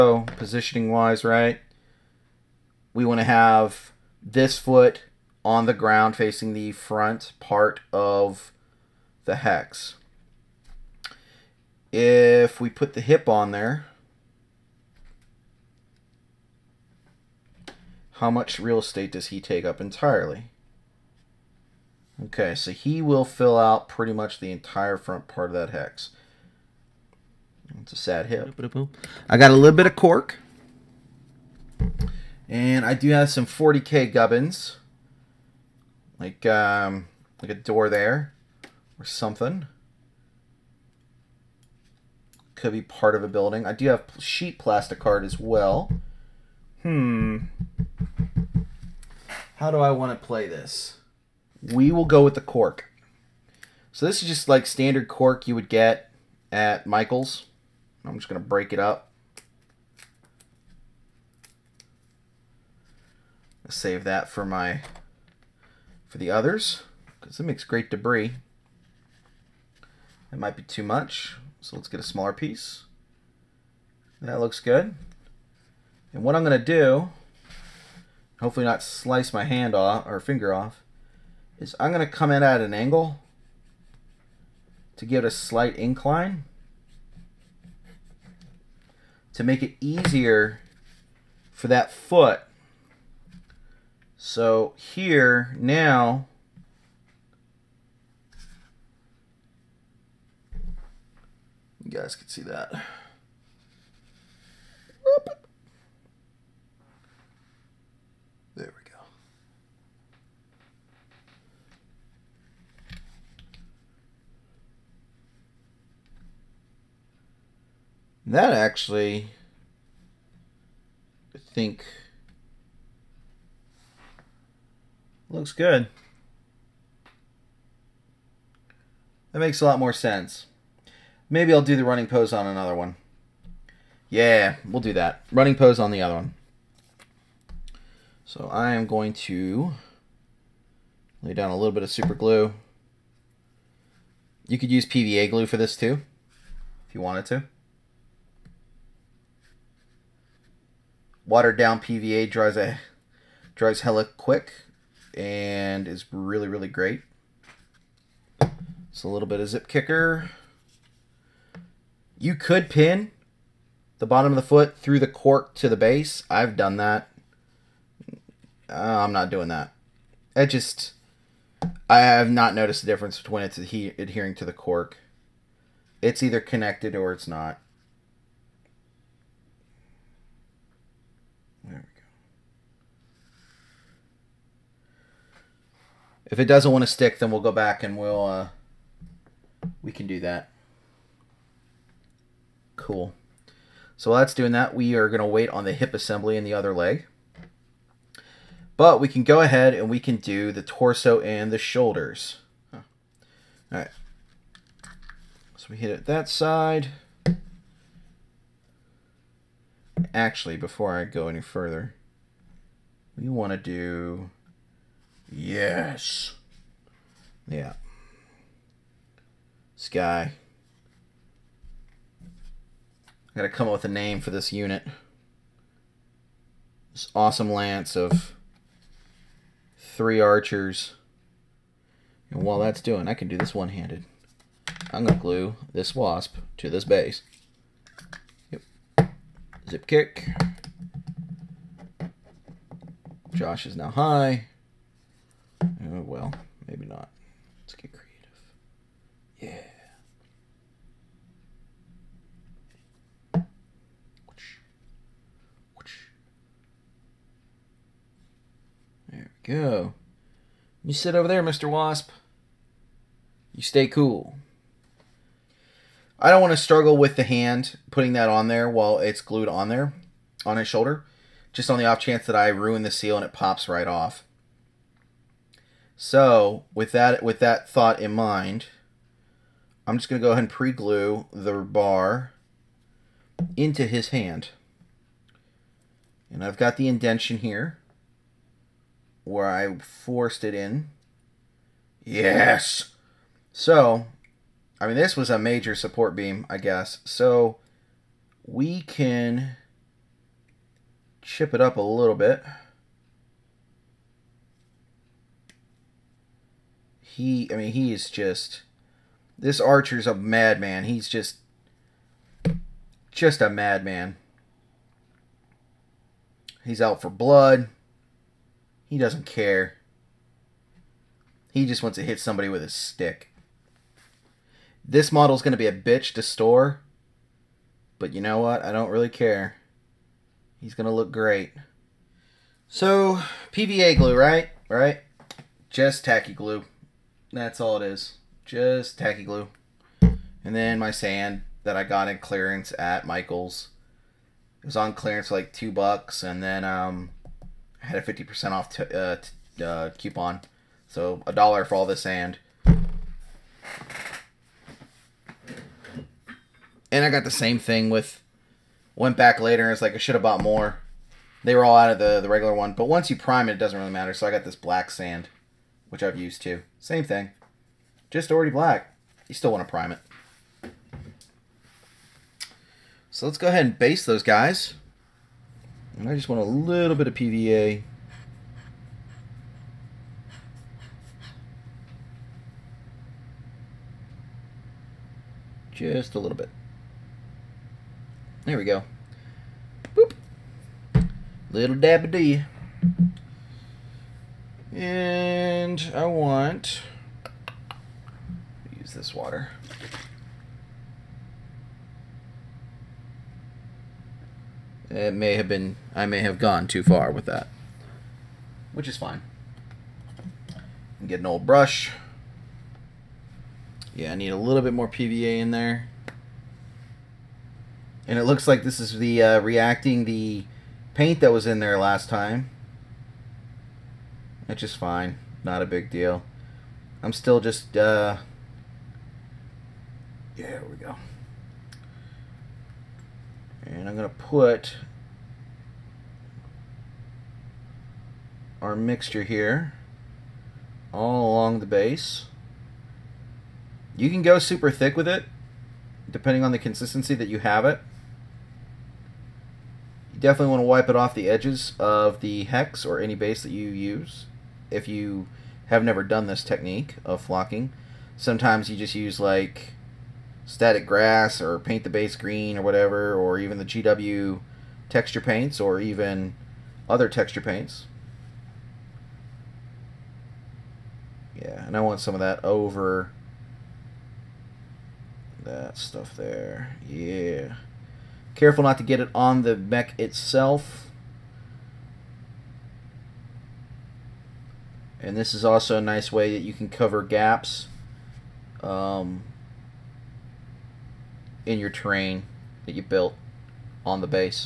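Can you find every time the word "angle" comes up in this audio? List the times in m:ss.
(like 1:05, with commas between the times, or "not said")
1:22.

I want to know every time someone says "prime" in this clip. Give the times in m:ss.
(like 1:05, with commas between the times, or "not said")
6:03, 6:09.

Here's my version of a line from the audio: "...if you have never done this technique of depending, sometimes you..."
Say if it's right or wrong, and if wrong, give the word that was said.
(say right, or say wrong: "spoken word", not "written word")
wrong: "flocking", not "depending".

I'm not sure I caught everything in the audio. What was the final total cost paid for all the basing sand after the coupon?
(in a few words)
A dollar.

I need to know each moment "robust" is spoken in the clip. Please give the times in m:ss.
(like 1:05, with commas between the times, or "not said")
not said.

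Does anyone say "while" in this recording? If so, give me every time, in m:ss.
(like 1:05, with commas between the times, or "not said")
3:14, 3:52, 4:28.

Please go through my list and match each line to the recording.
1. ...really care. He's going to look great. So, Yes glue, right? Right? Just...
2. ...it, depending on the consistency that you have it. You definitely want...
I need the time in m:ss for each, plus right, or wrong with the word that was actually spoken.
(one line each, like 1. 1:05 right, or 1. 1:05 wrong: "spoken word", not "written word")
1. 5:28 wrong: "PVA", not "Yes"
2. 7:25 right.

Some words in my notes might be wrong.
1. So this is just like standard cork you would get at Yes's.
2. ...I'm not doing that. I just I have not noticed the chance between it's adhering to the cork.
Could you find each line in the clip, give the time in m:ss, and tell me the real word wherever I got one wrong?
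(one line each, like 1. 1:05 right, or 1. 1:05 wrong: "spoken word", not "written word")
1. 0:53 wrong: "Michael", not "Yes"
2. 2:48 wrong: "difference", not "chance".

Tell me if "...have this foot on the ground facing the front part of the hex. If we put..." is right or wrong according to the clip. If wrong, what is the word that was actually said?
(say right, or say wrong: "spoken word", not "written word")
right.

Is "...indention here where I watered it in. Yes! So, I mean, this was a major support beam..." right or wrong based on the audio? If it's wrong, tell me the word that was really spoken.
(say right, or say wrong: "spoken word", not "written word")
wrong: "forced", not "watered".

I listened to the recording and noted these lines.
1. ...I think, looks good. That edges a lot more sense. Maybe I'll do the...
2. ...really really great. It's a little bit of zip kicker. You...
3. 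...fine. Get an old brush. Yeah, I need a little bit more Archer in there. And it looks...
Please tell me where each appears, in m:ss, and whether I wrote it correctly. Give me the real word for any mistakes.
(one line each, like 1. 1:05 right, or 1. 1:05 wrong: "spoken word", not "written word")
1. 2:01 wrong: "makes", not "edges"
2. 2:36 right
3. 6:48 wrong: "PVA", not "Archer".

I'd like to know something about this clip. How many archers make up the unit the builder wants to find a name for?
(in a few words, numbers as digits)
3.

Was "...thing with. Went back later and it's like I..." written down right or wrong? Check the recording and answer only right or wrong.
right.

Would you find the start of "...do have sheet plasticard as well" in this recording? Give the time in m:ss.
0:43.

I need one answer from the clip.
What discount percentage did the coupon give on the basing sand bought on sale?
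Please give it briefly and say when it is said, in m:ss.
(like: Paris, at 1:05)
50%, at 5:48.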